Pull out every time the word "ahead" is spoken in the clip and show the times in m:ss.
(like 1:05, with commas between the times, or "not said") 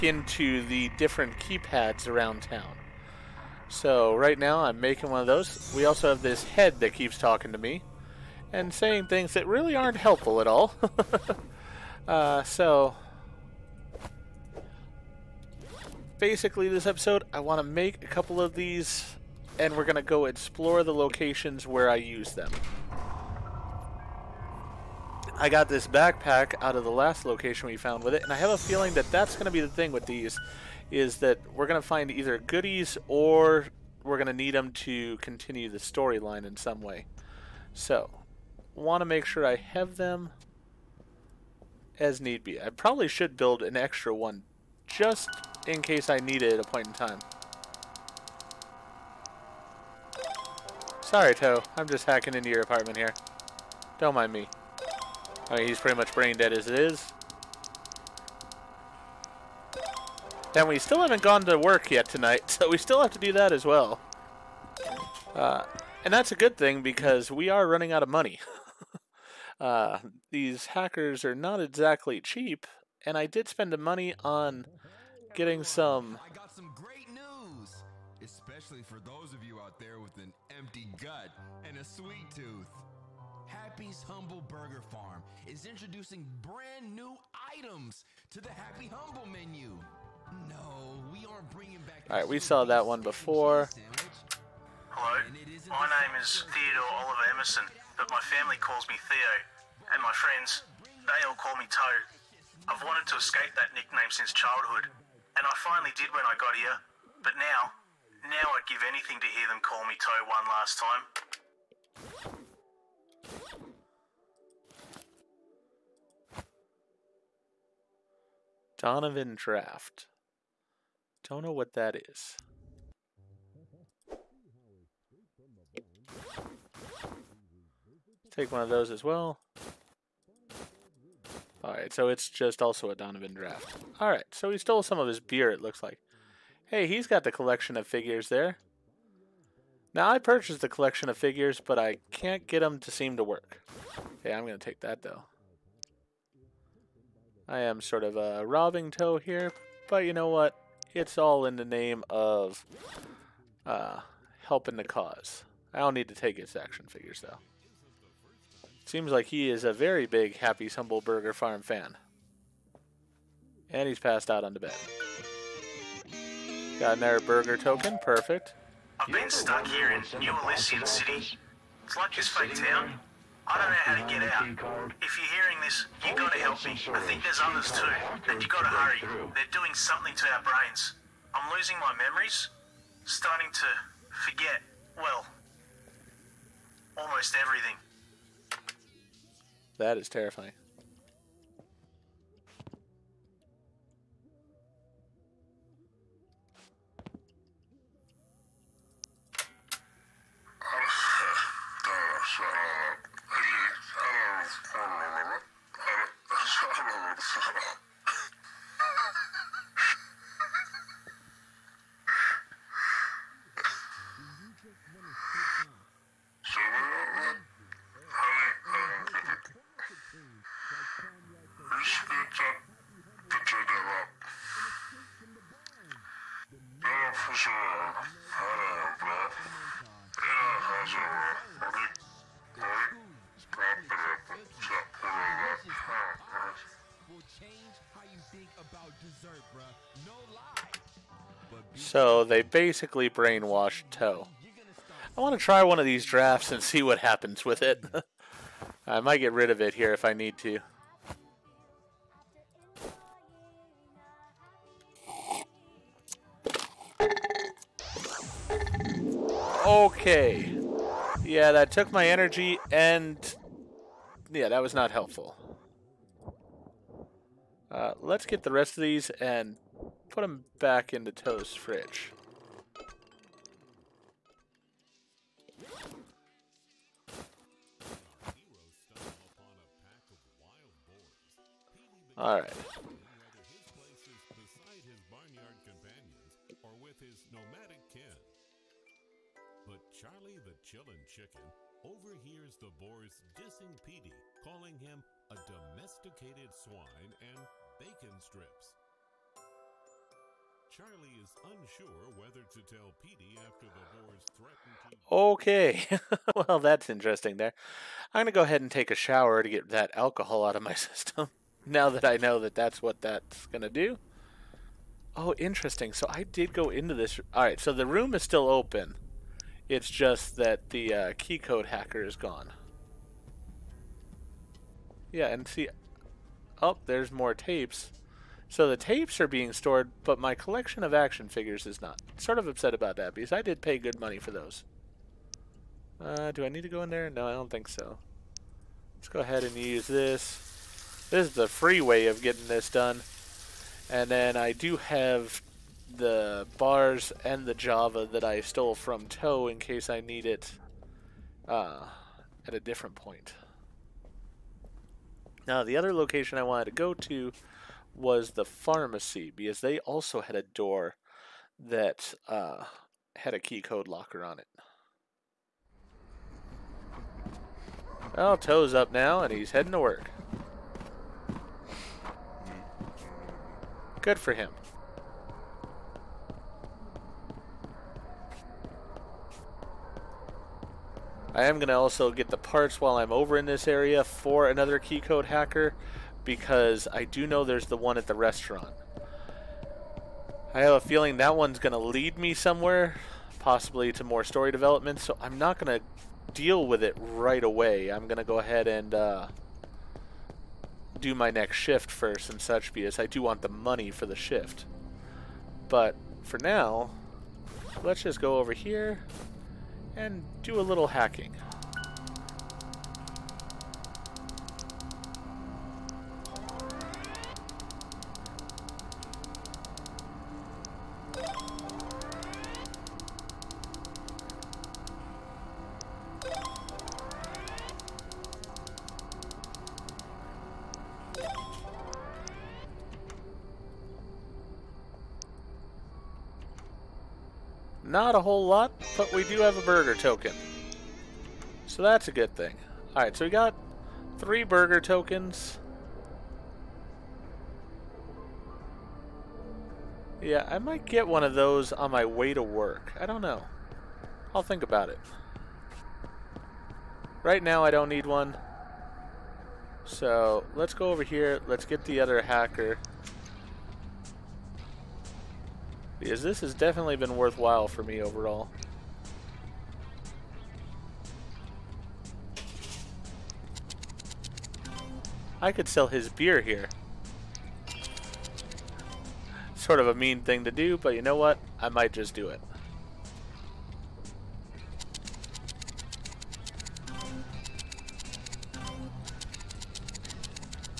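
5:08, 5:39, 6:38.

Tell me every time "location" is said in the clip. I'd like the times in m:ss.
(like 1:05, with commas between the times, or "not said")
0:20, 0:27, 5:55.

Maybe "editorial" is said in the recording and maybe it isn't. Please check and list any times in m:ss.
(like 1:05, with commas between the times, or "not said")
not said.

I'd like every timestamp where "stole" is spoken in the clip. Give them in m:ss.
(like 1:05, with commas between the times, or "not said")
2:14, 5:48.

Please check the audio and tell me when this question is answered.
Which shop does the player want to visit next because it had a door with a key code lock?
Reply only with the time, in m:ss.
5:58.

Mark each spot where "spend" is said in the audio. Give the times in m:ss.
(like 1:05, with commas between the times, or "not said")
1:13.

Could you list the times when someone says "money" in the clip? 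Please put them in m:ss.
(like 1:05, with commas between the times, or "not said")
1:08, 1:13, 5:33, 6:43.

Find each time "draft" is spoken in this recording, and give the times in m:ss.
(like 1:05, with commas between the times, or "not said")
1:59, 2:13, 4:06.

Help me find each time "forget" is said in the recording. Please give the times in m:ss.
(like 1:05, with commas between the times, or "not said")
3:04.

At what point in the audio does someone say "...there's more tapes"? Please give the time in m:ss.
5:26.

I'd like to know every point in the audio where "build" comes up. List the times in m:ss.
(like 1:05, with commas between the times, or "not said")
0:43.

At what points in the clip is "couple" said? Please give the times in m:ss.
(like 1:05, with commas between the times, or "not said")
0:18.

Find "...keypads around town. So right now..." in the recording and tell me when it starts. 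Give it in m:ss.
0:01.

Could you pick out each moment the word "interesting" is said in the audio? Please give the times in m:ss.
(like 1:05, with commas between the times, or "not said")
5:06, 5:15.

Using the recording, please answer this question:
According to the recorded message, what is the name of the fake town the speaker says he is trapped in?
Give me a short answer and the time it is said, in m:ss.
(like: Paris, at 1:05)
New Elysian City, at 2:50.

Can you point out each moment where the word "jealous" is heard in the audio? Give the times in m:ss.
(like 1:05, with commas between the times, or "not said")
not said.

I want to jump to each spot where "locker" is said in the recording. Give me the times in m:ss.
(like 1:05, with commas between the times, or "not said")
6:03.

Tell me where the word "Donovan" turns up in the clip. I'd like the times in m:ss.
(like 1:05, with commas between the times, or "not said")
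1:58, 2:12.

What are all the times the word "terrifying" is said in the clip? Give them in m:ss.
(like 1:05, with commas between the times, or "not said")
3:10.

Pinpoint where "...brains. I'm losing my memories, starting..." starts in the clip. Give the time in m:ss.
3:00.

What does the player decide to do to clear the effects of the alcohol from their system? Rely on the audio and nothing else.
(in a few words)
Take a shower.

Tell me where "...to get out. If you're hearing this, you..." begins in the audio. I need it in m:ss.
2:53.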